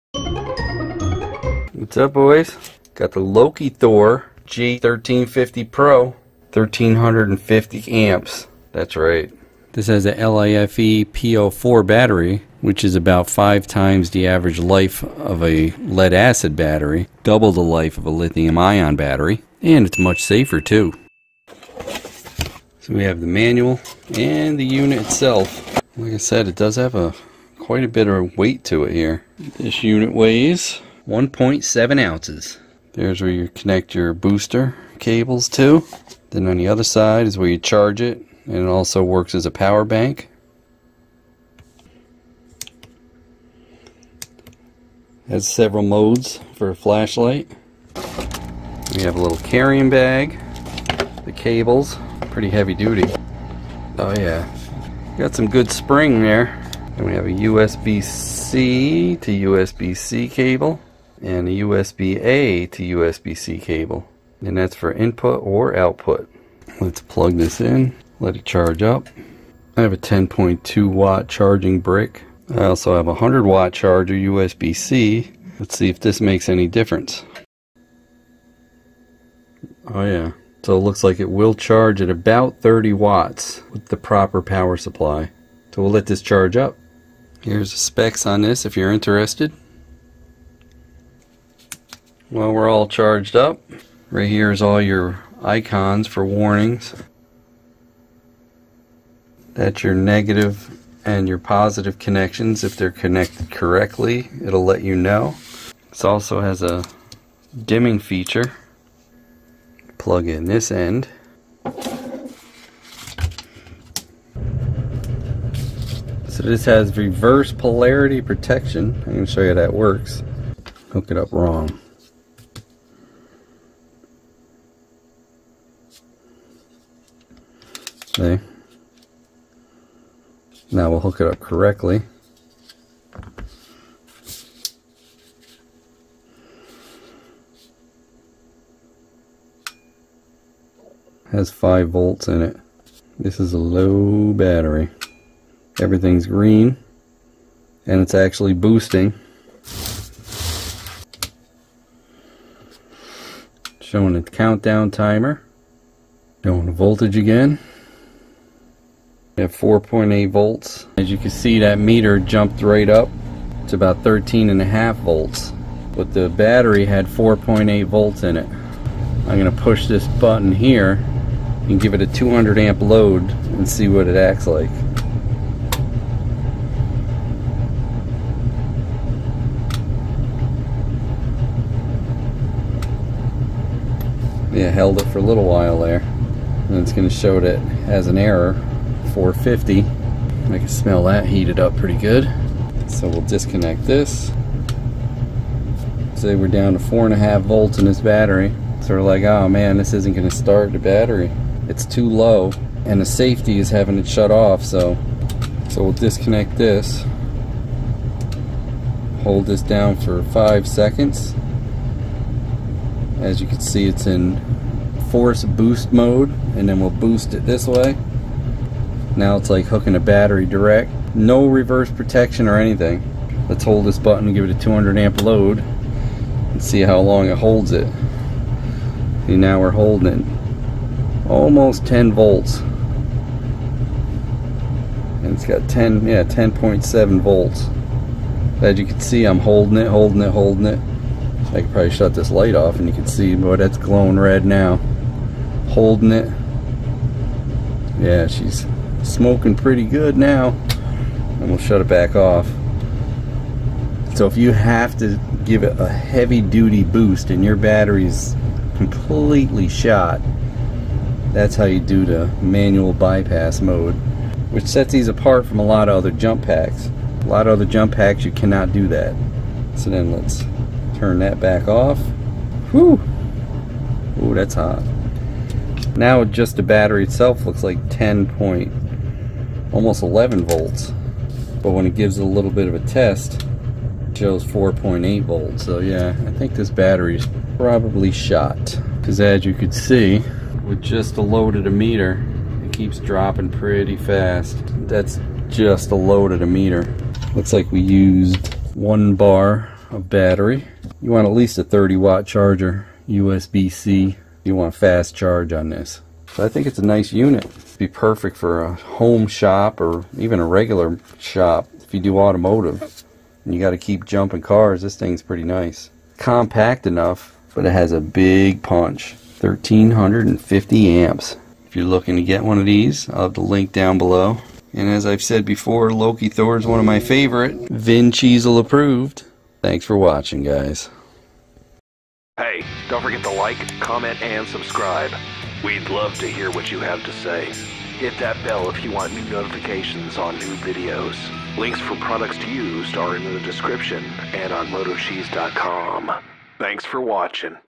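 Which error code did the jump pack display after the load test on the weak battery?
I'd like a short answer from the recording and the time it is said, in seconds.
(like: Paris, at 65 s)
450, at 188 s.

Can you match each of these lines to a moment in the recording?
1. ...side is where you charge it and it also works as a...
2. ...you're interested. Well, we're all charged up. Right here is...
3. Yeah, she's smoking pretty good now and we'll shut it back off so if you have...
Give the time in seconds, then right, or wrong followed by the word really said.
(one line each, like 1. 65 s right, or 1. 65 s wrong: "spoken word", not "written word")
1. 36 s right
2. 88 s right
3. 247 s right.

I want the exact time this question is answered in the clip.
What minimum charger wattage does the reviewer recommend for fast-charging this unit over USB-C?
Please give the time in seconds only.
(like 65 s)
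301 s.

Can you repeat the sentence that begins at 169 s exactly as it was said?
I'm gonna push this button here and give it a 200 amp load and see what it acts like.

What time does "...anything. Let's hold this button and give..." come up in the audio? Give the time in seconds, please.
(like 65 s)
222 s.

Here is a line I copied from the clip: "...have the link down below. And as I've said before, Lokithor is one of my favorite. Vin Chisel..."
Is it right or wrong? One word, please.
right.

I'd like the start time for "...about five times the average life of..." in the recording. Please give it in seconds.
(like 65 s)
12 s.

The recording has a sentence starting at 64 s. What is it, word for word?
And that's for input or output.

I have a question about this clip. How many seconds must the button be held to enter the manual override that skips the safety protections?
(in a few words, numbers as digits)
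5 seconds.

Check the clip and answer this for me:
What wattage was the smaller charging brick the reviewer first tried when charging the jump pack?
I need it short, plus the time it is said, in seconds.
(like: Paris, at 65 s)
10.2 watt, at 69 s.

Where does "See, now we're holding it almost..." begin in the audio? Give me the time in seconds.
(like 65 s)
229 s.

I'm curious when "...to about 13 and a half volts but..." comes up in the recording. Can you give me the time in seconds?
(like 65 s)
163 s.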